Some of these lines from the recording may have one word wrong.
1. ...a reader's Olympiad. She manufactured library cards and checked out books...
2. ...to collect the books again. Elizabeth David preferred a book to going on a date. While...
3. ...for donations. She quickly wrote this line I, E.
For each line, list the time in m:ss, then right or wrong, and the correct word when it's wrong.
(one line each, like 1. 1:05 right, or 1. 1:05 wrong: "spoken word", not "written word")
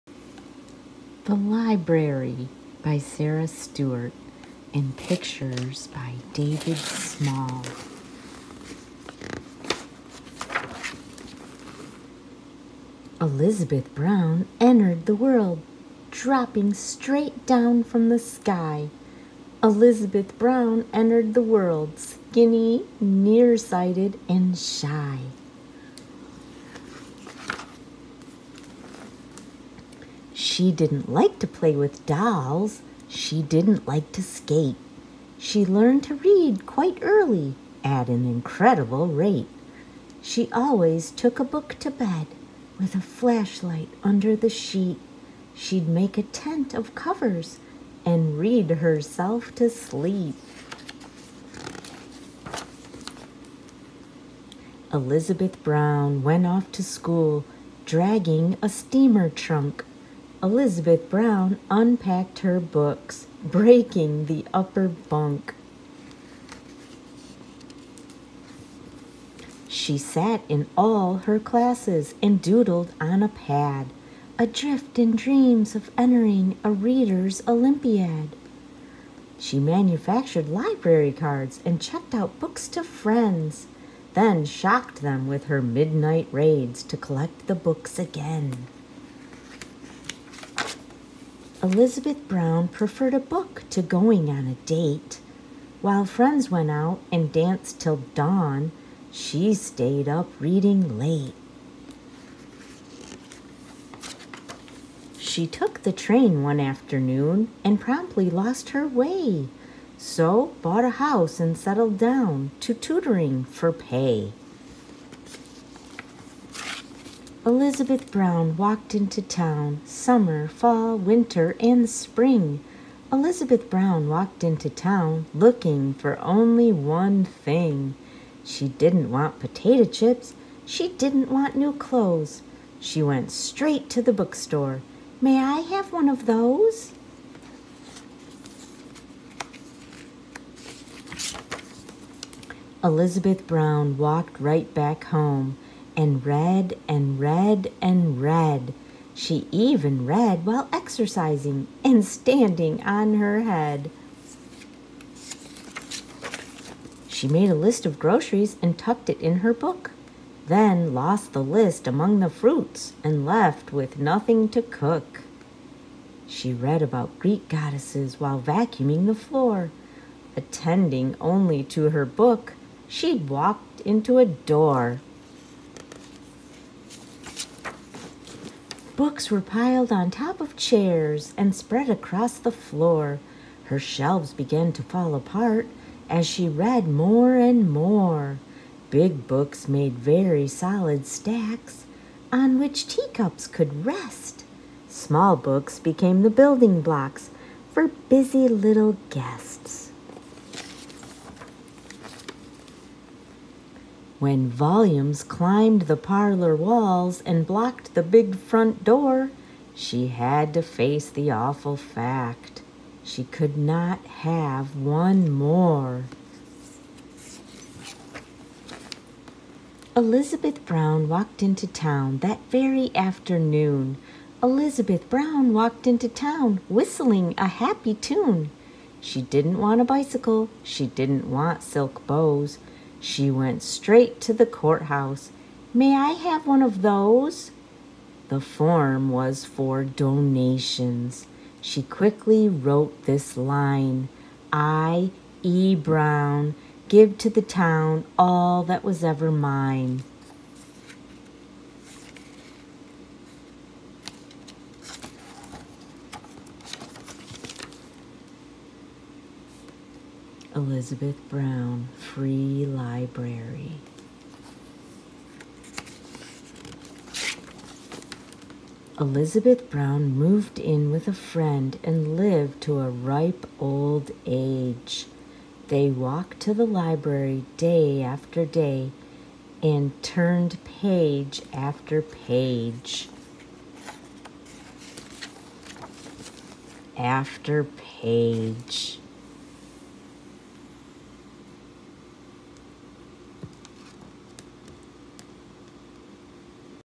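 1. 1:16 right
2. 1:26 wrong: "Brown", not "David"
3. 3:59 right.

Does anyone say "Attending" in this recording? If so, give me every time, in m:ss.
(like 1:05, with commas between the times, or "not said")
2:50.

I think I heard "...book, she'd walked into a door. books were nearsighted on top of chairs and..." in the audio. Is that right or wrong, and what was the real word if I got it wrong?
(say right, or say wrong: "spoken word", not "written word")
wrong: "piled", not "nearsighted".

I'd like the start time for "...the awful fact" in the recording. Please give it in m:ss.
3:31.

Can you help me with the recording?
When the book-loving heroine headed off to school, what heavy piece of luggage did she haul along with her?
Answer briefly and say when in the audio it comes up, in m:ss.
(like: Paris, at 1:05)
steamer trunk, at 0:58.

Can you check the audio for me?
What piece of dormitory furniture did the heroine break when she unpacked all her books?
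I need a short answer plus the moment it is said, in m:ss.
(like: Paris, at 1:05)
upper bunk, at 1:04.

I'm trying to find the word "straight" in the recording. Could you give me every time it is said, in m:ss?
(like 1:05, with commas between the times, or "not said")
0:16, 2:13, 3:53.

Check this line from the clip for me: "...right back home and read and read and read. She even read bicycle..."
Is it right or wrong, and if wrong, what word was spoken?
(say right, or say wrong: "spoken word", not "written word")
wrong: "while", not "bicycle".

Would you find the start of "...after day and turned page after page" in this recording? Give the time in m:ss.
4:38.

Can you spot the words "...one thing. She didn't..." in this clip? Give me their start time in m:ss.
2:06.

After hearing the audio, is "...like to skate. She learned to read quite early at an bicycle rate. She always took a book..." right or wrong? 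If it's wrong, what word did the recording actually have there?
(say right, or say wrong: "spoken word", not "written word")
wrong: "incredible", not "bicycle".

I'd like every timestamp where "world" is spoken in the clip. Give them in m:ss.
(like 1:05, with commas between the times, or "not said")
0:15, 0:21.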